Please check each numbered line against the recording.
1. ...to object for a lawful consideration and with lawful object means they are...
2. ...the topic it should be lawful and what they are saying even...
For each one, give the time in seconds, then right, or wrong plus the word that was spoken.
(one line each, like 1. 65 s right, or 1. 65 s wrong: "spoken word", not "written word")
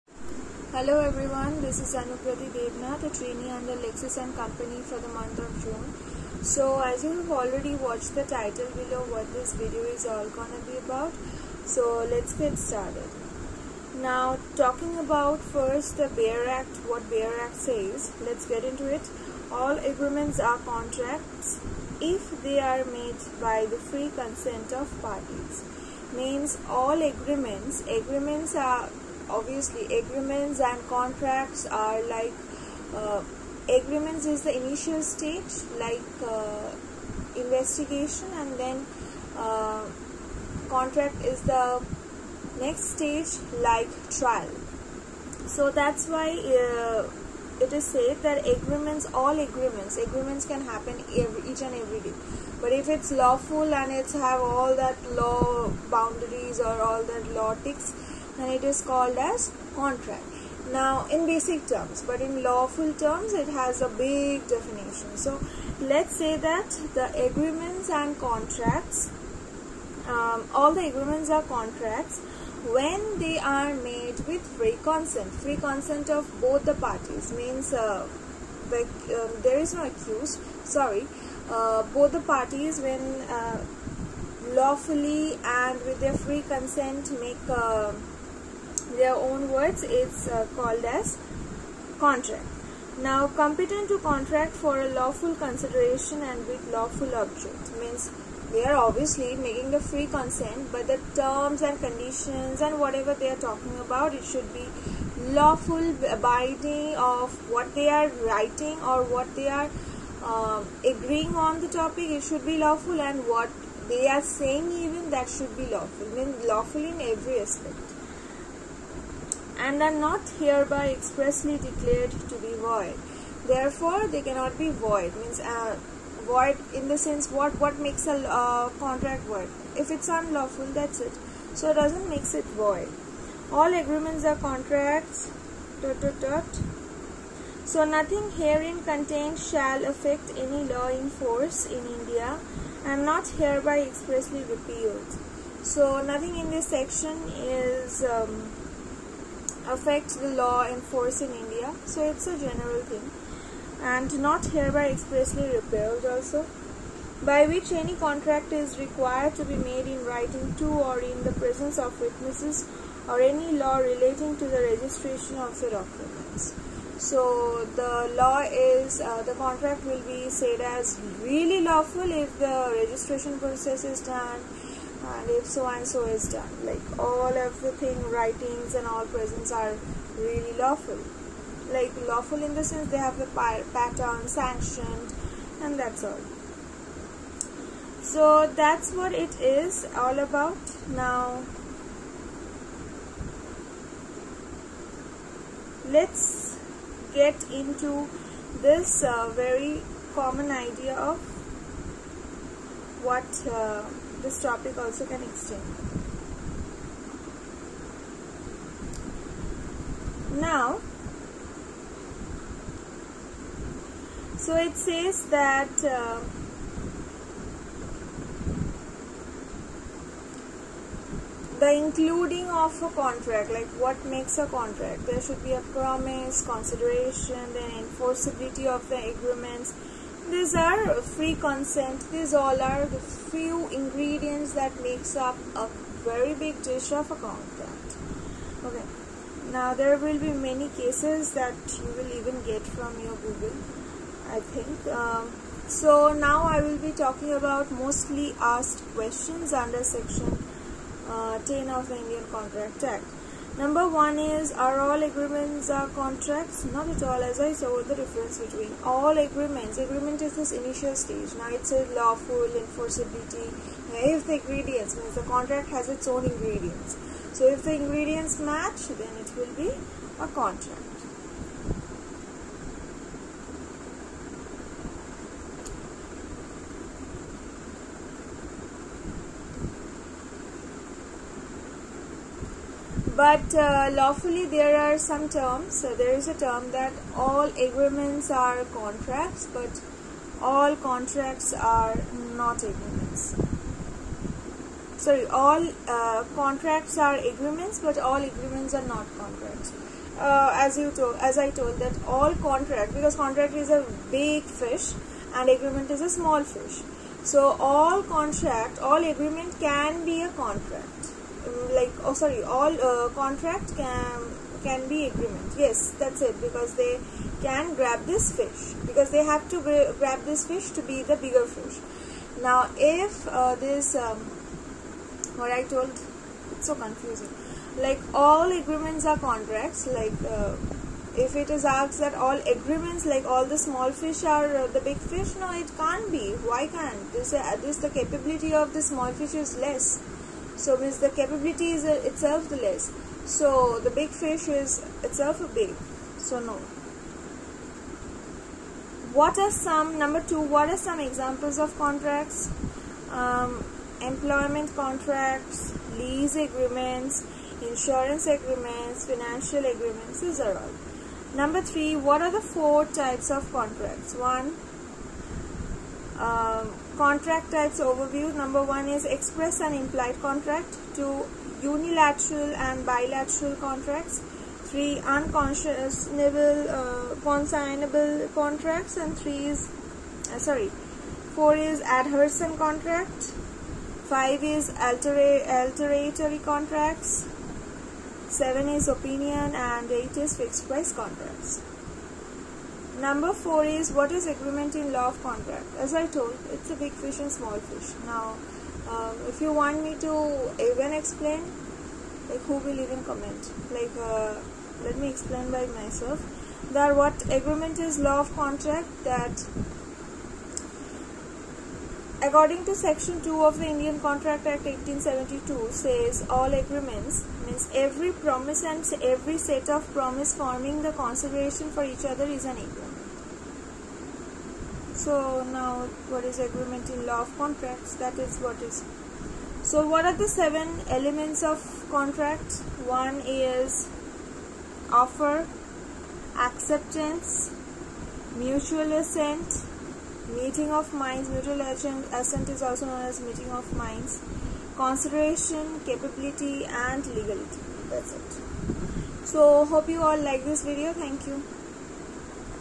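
1. 93 s wrong: "contract", not "object"
2. 111 s right.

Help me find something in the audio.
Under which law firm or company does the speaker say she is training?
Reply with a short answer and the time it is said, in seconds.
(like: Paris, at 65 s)
Lexis and Company, at 3 s.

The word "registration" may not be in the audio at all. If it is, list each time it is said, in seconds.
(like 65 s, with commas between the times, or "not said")
164 s, 172 s.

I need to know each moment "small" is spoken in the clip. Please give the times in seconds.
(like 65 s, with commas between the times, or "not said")
306 s, 333 s, 338 s, 397 s.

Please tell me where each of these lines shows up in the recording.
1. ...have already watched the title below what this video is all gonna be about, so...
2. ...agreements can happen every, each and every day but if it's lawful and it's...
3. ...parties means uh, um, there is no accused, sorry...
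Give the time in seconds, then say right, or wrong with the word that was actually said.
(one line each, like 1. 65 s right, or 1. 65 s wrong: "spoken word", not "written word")
1. 7 s right
2. 49 s right
3. 76 s right.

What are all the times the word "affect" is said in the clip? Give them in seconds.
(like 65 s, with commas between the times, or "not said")
139 s, 149 s.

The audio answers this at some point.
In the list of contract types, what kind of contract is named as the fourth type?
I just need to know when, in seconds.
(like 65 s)
381 s.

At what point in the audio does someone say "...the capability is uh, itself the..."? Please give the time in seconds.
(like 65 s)
340 s.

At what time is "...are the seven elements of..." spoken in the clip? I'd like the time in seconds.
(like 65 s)
430 s.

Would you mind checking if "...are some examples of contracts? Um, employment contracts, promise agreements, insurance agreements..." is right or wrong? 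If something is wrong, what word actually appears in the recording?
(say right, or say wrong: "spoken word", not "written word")
wrong: "lease", not "promise".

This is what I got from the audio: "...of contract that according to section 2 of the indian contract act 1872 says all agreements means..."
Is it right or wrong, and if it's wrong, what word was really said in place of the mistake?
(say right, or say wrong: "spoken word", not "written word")
right.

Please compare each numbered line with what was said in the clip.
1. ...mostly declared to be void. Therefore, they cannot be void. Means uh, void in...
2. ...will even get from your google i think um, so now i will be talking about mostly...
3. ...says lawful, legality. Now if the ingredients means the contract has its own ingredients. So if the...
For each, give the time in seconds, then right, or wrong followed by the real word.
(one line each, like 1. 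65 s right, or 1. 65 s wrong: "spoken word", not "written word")
1. 120 s wrong: "expressly", not "mostly"
2. 241 s right
3. 261 s wrong: "enforceability", not "legality".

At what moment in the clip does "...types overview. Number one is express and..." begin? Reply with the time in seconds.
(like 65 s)
367 s.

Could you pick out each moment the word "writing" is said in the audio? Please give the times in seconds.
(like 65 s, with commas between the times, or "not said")
108 s, 160 s, 178 s.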